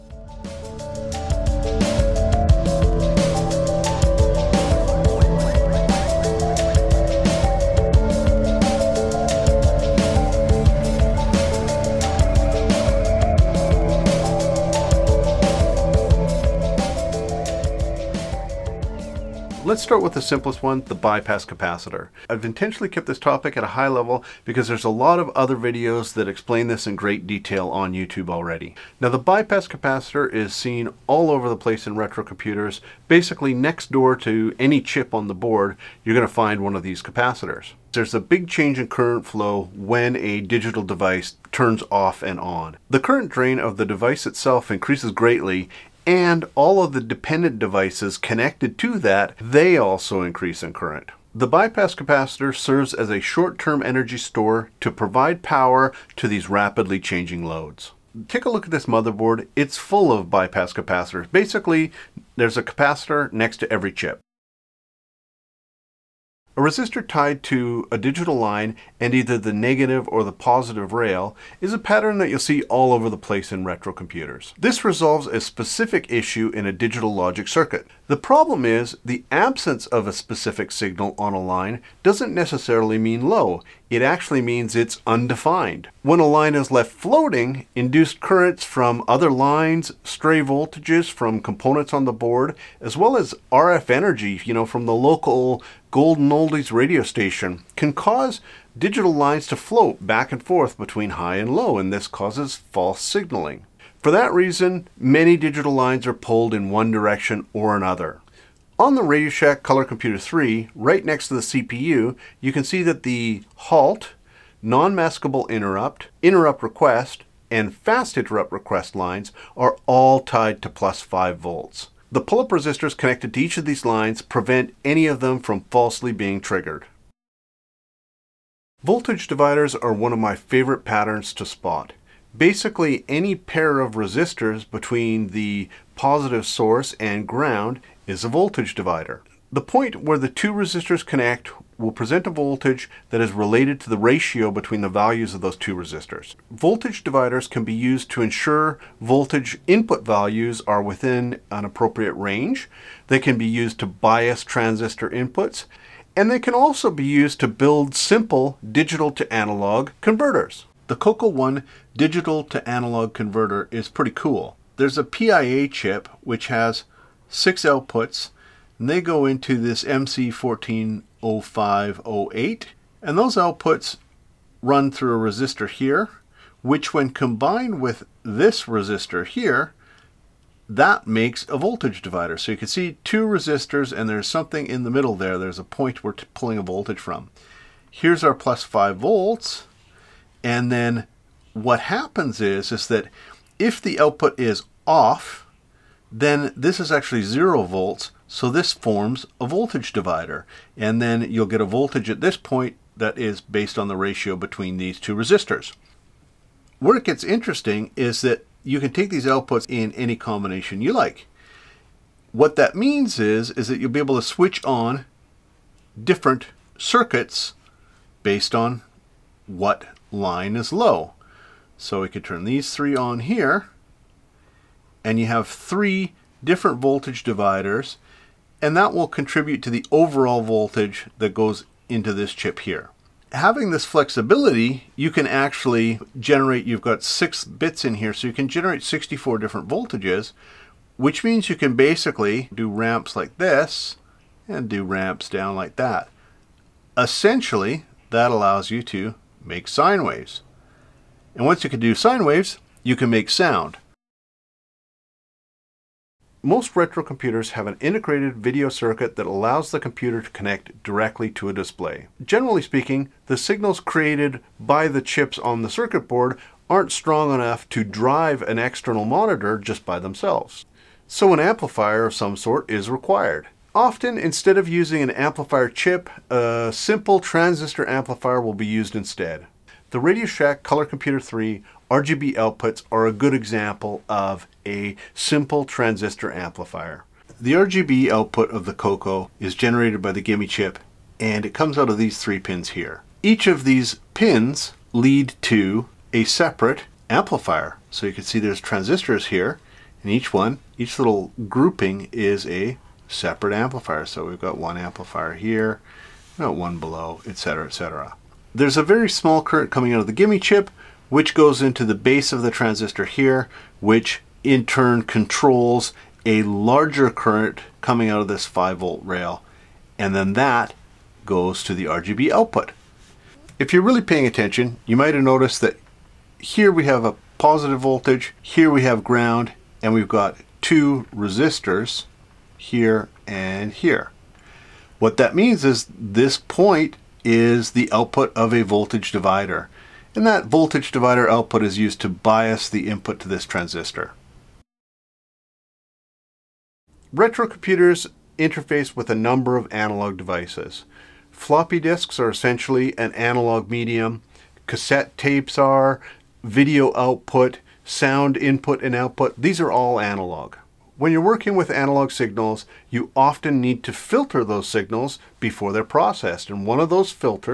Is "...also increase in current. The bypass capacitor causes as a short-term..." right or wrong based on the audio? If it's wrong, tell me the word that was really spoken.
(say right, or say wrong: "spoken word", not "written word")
wrong: "serves", not "causes".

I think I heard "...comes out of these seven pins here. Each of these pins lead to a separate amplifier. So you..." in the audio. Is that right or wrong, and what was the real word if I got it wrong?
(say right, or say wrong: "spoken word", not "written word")
wrong: "three", not "seven".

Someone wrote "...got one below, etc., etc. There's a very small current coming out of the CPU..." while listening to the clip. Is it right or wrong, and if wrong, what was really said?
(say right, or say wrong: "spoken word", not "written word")
wrong: "GIME", not "CPU".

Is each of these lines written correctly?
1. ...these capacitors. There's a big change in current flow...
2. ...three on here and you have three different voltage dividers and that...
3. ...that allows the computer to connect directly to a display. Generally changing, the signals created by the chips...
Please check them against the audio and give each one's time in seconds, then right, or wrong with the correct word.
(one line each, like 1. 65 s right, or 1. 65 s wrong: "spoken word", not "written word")
1. 36 s right
2. 222 s right
3. 259 s wrong: "speaking", not "changing".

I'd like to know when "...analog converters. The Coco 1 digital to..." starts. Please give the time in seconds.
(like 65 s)
159 s.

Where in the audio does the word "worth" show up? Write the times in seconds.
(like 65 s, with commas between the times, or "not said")
not said.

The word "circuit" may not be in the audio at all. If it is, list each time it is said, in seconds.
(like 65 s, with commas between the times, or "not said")
77 s, 216 s, 258 s, 265 s.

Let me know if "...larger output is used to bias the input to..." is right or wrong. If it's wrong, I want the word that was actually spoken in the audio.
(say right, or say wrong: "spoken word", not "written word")
wrong: "divider", not "larger".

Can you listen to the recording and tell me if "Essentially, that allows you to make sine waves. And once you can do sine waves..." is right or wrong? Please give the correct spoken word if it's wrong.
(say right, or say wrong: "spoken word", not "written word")
right.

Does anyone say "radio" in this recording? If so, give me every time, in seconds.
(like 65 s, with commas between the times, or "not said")
96 s, 109 s, 280 s.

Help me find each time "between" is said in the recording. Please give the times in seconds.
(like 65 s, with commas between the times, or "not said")
100 s, 134 s, 144 s, 204 s.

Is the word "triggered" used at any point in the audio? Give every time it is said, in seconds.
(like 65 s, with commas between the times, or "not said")
126 s.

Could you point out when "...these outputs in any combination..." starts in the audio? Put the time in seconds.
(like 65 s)
209 s.